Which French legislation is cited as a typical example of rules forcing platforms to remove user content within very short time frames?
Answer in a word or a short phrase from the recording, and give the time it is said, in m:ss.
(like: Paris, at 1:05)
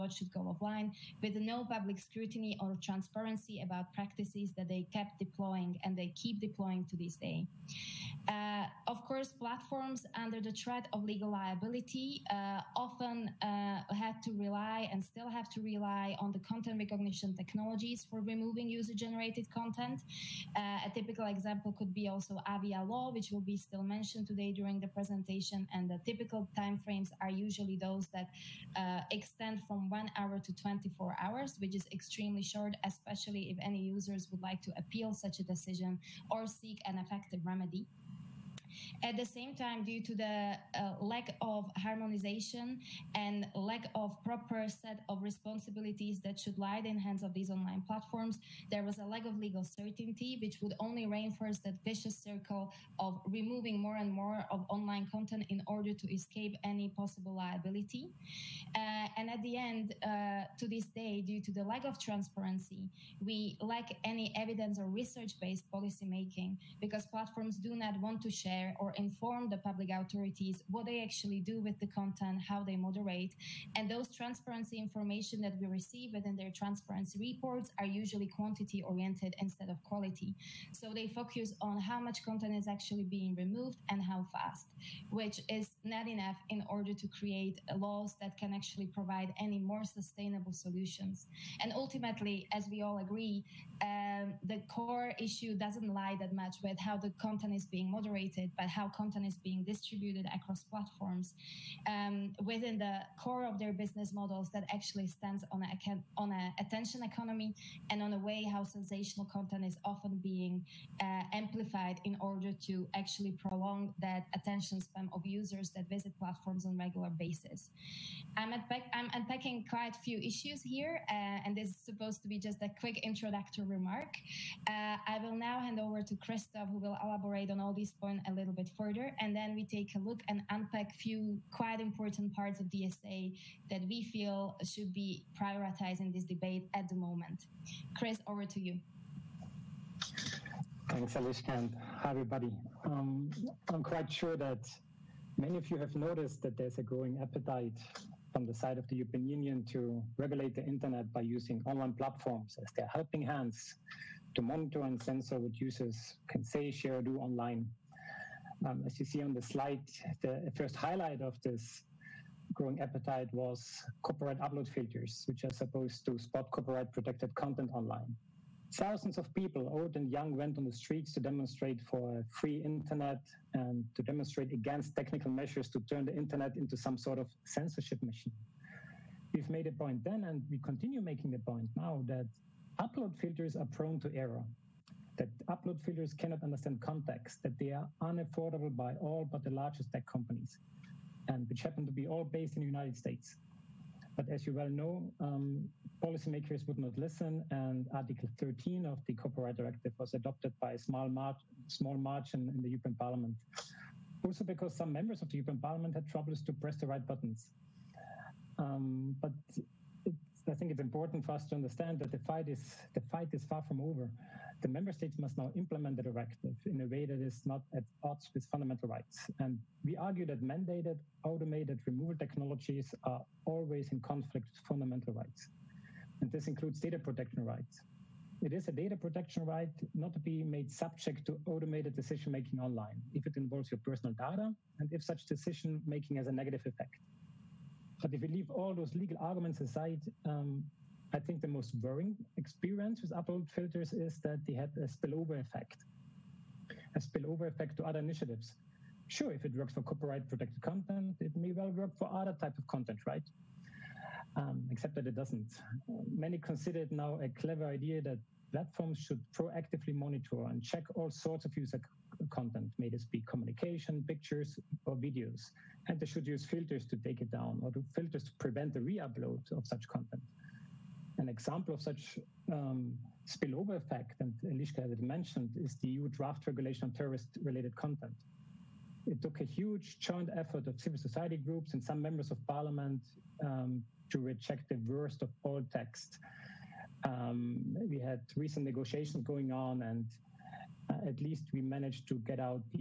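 Avia Law, at 0:22.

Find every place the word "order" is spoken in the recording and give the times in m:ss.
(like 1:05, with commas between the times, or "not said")
0:55, 1:26, 1:52.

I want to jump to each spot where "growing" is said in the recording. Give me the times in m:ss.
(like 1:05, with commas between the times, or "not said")
2:26, 2:42.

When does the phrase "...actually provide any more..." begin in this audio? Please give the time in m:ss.
1:28.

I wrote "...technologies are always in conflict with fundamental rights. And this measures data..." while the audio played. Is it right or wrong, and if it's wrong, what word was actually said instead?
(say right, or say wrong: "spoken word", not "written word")
wrong: "includes", not "measures".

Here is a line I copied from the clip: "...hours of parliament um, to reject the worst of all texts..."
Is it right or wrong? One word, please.
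wrong.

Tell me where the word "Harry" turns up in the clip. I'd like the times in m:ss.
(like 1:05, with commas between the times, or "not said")
not said.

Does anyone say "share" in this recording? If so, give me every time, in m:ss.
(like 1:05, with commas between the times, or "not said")
1:08, 2:36.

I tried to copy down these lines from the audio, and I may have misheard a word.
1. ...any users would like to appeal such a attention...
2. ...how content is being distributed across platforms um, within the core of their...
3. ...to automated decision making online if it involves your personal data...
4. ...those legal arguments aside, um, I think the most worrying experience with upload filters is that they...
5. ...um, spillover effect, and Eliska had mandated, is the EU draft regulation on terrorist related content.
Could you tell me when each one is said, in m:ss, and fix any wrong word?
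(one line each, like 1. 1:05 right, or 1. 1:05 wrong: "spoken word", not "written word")
1. 0:33 wrong: "decision", not "attention"
2. 1:38 right
3. 3:51 right
4. 3:58 right
5. 4:32 wrong: "mentioned", not "mandated".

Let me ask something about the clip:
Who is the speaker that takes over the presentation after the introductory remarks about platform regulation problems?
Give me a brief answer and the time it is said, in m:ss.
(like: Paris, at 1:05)
Christoph, at 2:06.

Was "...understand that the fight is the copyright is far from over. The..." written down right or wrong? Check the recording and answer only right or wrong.
wrong.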